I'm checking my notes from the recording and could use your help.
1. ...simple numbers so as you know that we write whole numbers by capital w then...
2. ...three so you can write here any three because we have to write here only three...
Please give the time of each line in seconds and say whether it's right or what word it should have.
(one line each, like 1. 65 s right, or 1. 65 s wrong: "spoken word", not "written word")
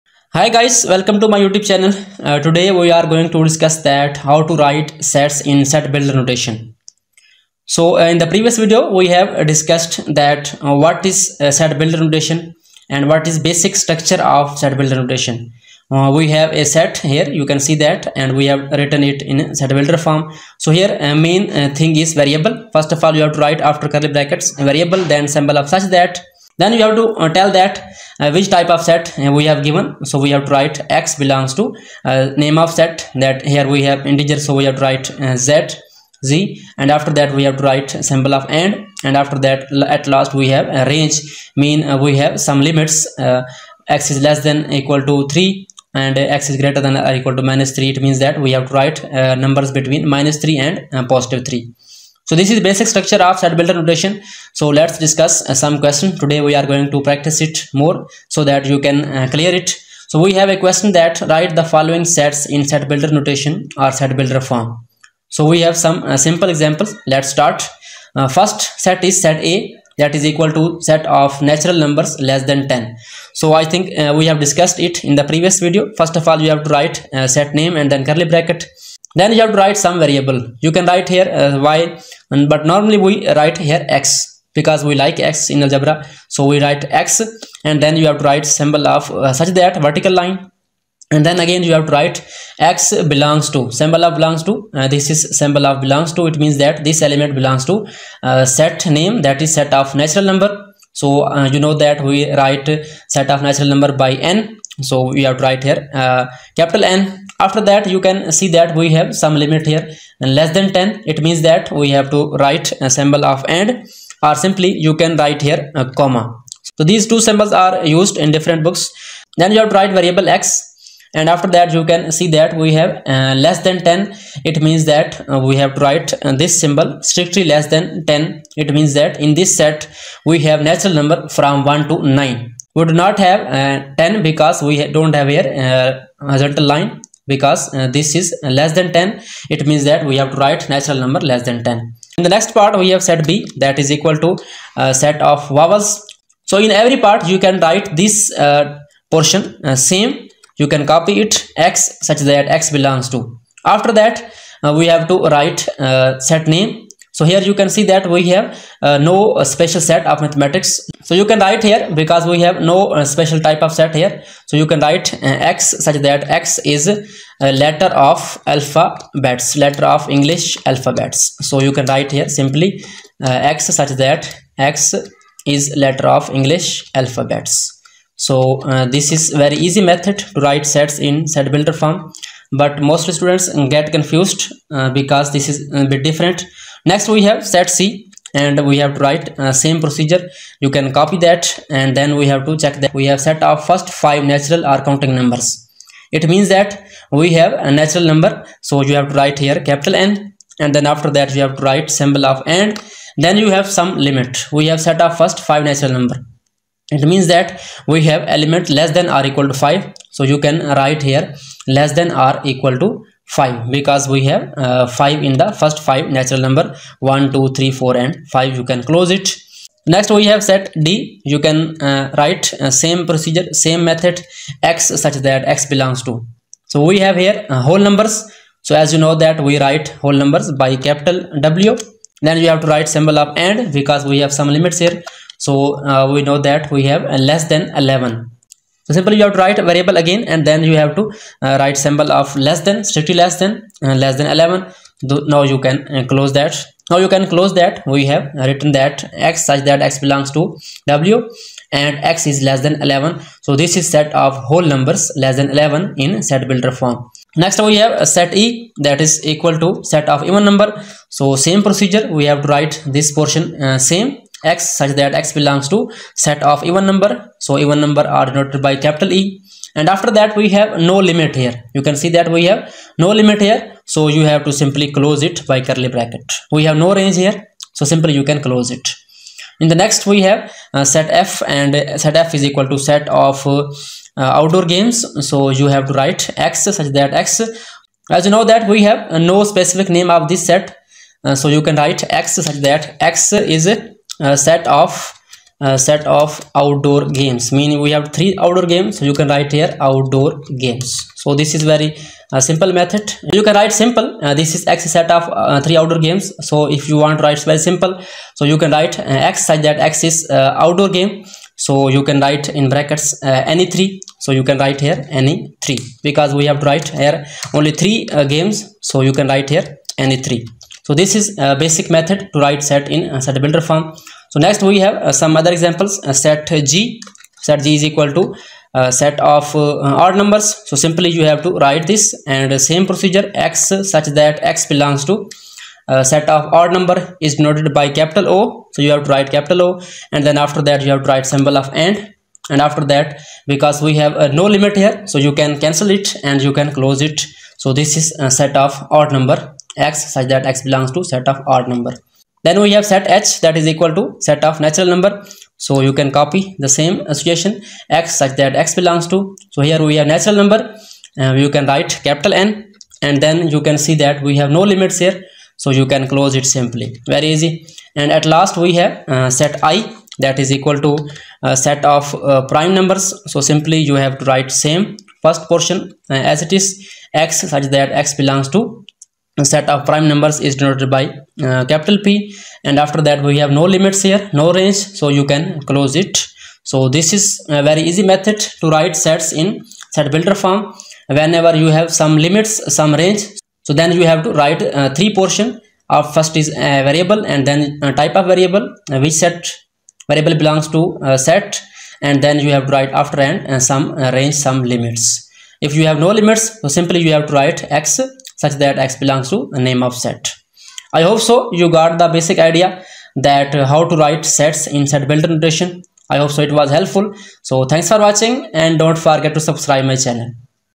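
1. 227 s wrong: "whole", not "simple"
2. 313 s right.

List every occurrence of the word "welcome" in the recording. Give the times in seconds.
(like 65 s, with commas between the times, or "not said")
0 s.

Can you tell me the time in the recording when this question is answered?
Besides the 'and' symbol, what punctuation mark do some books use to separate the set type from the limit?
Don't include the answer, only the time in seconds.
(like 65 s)
115 s.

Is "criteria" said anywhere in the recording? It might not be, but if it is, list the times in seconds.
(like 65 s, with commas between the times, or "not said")
not said.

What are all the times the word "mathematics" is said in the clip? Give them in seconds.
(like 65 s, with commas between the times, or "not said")
160 s.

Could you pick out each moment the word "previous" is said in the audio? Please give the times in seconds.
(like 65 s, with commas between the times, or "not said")
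8 s, 75 s.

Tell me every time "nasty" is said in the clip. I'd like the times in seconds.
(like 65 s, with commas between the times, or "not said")
not said.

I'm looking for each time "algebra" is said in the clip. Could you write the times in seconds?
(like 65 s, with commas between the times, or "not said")
85 s.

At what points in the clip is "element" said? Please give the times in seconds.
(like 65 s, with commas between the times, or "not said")
97 s, 208 s.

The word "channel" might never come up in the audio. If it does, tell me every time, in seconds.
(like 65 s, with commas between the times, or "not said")
1 s, 420 s.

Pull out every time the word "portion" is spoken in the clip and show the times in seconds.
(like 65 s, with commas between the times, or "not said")
149 s, 263 s, 375 s, 395 s.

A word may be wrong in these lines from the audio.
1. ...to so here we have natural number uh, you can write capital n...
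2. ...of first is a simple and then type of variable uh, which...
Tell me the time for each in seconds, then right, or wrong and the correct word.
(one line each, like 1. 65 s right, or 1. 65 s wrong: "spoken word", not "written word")
1. 359 s right
2. 395 s wrong: "variable", not "simple".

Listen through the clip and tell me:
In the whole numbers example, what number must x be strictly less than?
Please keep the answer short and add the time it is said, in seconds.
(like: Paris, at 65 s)
11, at 244 s.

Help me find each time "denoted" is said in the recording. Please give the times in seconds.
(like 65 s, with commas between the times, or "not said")
268 s, 337 s, 380 s.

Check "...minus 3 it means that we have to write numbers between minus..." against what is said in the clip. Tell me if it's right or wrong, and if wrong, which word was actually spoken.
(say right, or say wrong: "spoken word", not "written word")
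right.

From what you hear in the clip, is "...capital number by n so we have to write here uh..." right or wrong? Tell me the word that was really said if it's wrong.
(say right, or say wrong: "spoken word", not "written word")
wrong: "natural", not "capital".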